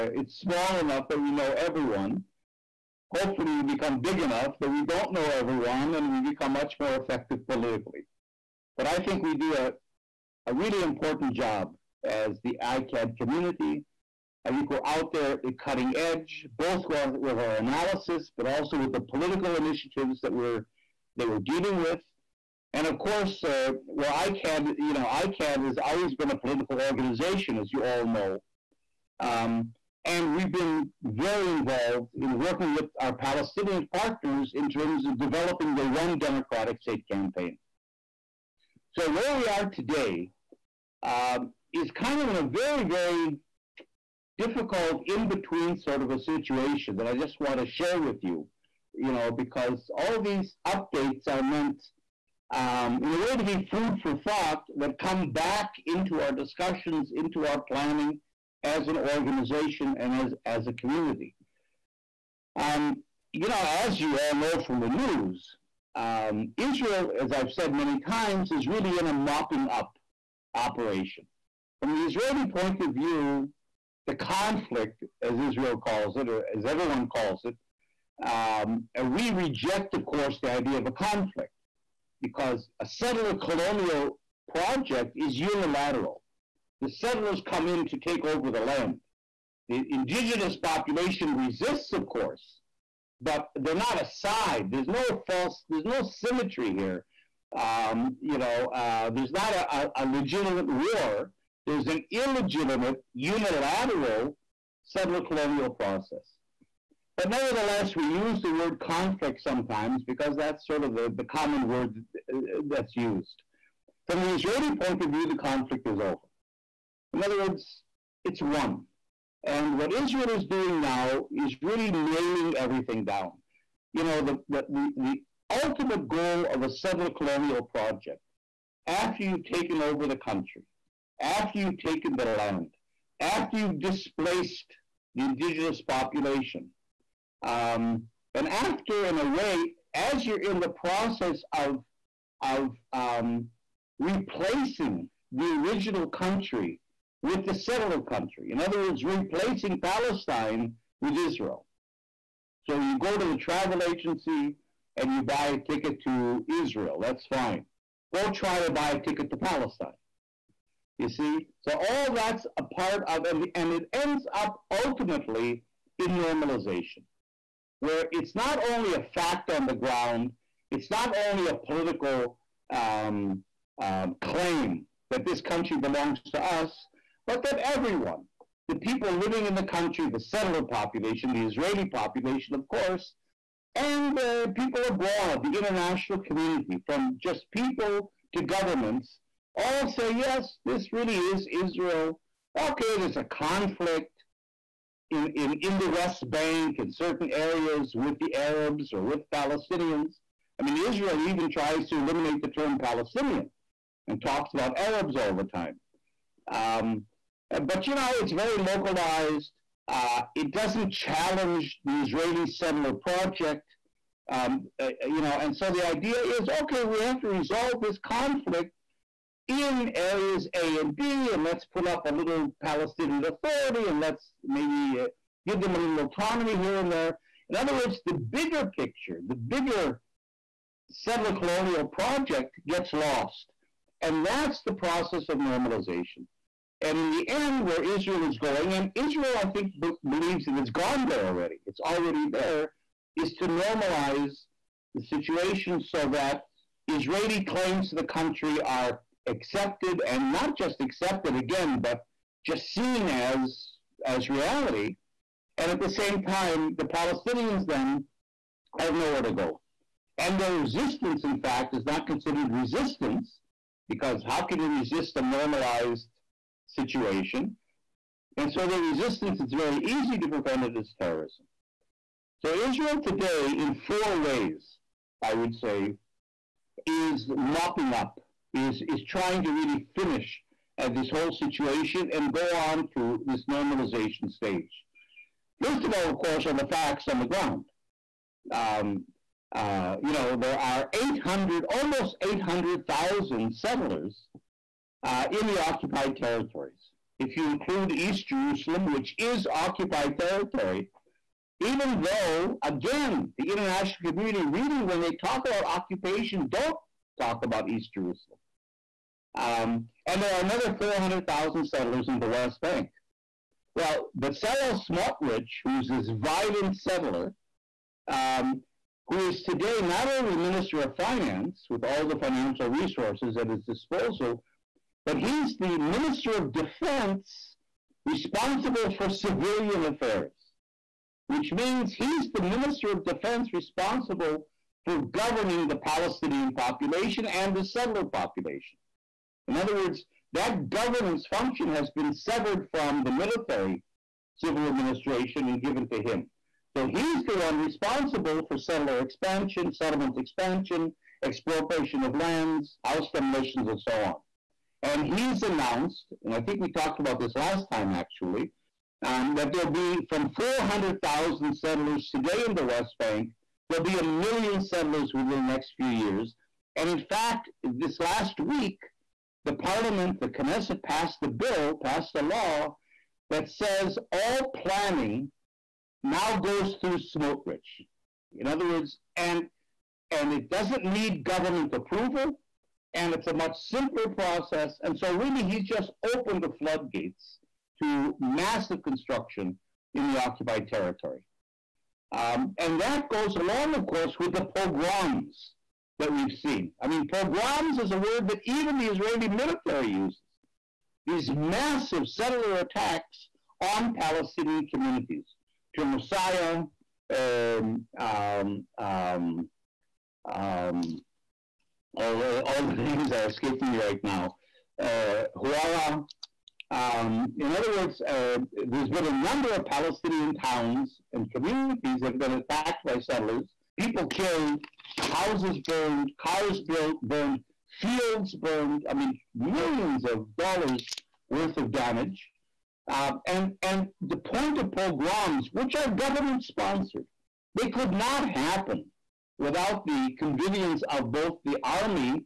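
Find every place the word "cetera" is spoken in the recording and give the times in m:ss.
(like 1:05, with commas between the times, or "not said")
not said.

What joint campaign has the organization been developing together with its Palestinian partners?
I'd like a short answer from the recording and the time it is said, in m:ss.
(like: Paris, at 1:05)
One Democratic State campaign, at 0:35.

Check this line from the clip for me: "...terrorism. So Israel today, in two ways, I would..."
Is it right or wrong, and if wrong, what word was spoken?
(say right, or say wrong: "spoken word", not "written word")
wrong: "four", not "two".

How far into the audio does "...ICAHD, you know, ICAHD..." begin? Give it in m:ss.
0:24.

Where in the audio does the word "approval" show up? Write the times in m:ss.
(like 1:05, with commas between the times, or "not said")
6:21.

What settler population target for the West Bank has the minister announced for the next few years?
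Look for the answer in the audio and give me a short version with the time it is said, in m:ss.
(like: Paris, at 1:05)
1 million, at 6:03.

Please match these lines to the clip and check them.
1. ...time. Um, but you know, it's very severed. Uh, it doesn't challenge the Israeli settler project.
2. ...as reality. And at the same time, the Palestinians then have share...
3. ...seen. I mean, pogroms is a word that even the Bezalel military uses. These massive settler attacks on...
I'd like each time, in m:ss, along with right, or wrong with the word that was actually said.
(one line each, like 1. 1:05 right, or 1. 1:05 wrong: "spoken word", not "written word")
1. 3:25 wrong: "localized", not "severed"
2. 4:14 wrong: "nowhere", not "share"
3. 6:36 wrong: "Israeli", not "Bezalel".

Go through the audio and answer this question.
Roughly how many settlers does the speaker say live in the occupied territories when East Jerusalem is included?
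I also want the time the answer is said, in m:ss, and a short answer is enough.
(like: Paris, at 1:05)
800,000, at 4:51.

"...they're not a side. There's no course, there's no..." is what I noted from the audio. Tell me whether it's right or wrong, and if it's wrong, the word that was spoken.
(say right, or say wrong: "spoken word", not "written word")
wrong: "false", not "course".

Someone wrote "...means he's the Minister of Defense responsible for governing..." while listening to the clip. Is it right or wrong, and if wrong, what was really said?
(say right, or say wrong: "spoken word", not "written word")
right.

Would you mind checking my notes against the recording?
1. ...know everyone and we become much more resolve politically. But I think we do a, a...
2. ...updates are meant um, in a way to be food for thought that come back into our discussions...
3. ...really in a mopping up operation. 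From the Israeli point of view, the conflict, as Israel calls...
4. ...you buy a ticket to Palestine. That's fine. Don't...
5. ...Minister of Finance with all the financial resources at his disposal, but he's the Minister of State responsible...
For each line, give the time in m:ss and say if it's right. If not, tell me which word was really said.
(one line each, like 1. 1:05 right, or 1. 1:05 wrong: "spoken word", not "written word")
1. 0:05 wrong: "effective", not "resolve"
2. 0:50 right
3. 1:08 right
4. 2:35 wrong: "Israel", not "Palestine"
5. 5:20 wrong: "Defense", not "State".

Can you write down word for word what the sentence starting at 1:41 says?
There's an illegitimate, unilateral settler colonial process.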